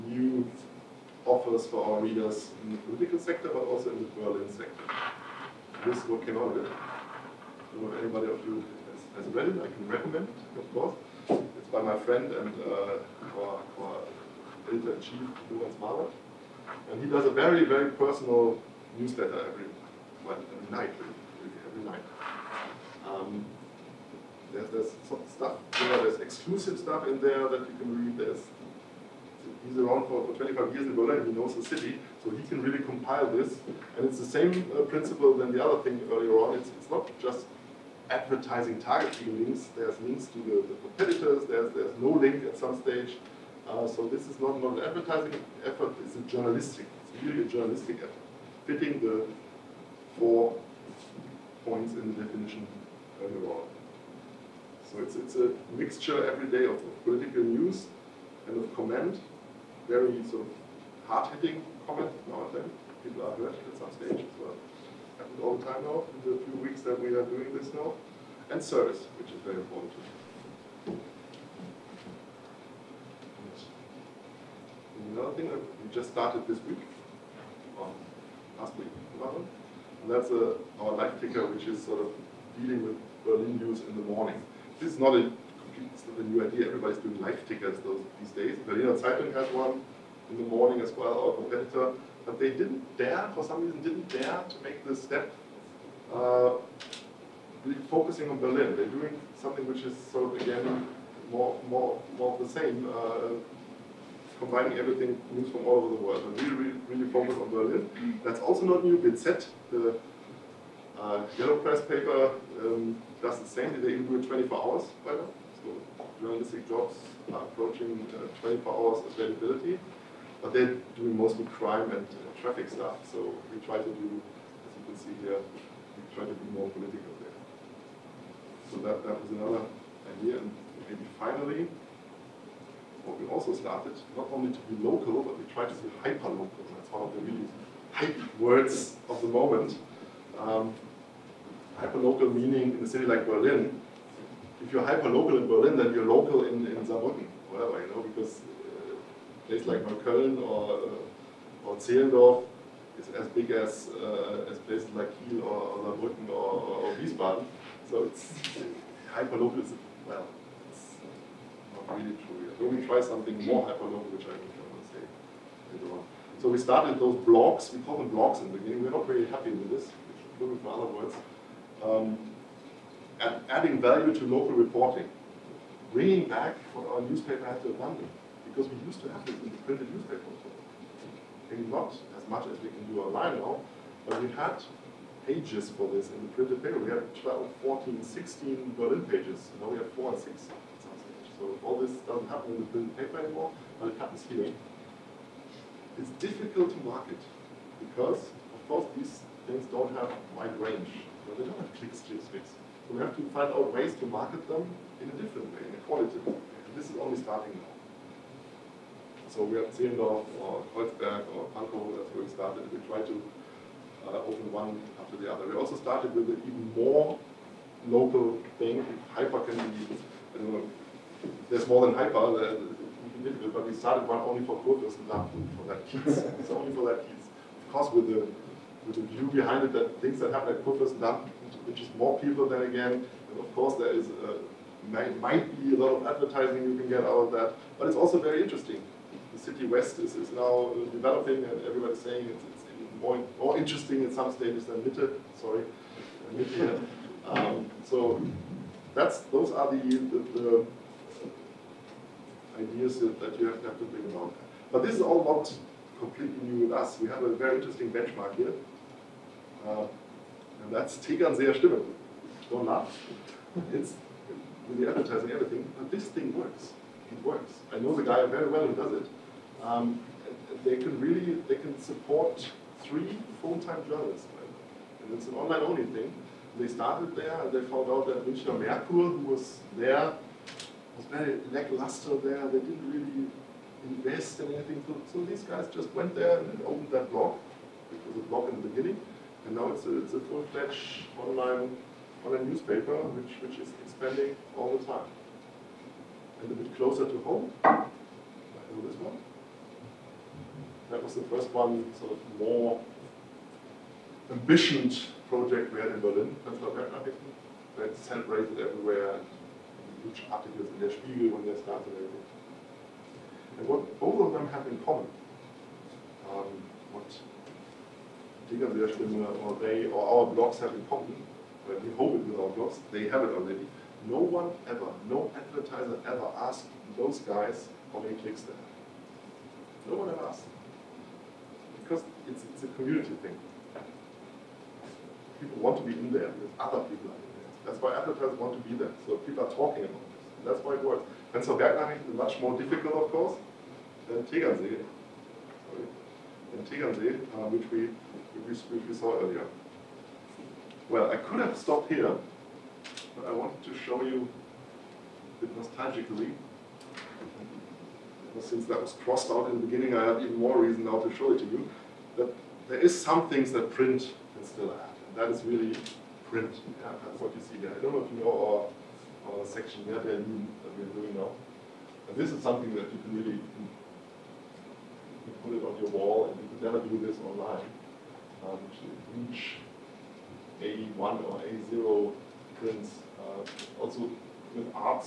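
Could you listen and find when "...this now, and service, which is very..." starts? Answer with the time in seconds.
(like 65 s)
67 s.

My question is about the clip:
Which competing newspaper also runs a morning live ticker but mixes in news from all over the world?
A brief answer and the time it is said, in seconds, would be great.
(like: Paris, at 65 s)
Berliner Zeitung, at 88 s.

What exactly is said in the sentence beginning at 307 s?
They celebrated everywhere, huge articles in Der Spiegel when they started everything.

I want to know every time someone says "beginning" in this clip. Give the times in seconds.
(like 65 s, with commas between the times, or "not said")
168 s, 288 s, 359 s.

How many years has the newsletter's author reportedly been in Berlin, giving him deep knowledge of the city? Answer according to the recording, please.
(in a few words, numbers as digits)
25.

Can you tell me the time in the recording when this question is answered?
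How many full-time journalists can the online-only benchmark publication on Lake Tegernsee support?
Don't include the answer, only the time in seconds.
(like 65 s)
272 s.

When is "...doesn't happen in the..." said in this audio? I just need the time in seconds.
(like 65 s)
192 s.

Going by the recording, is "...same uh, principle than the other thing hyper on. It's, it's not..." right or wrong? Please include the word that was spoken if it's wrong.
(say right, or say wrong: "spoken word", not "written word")
wrong: "earlier", not "hyper".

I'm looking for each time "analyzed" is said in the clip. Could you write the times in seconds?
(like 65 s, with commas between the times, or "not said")
not said.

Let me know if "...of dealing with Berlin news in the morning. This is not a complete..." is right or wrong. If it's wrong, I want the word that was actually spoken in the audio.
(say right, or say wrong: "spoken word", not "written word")
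right.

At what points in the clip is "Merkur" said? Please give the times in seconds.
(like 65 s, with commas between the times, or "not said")
278 s.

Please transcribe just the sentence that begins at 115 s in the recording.
So journalistic jobs are approaching uh, 24 hours availability but they're doing mostly crime and uh, traffic stuff.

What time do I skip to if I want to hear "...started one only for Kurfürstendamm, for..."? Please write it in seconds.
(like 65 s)
223 s.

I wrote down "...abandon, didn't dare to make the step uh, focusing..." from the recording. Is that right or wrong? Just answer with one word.
wrong.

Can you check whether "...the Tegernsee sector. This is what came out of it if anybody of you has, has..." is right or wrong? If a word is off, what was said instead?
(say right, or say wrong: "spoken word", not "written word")
wrong: "Berlin", not "Tegernsee".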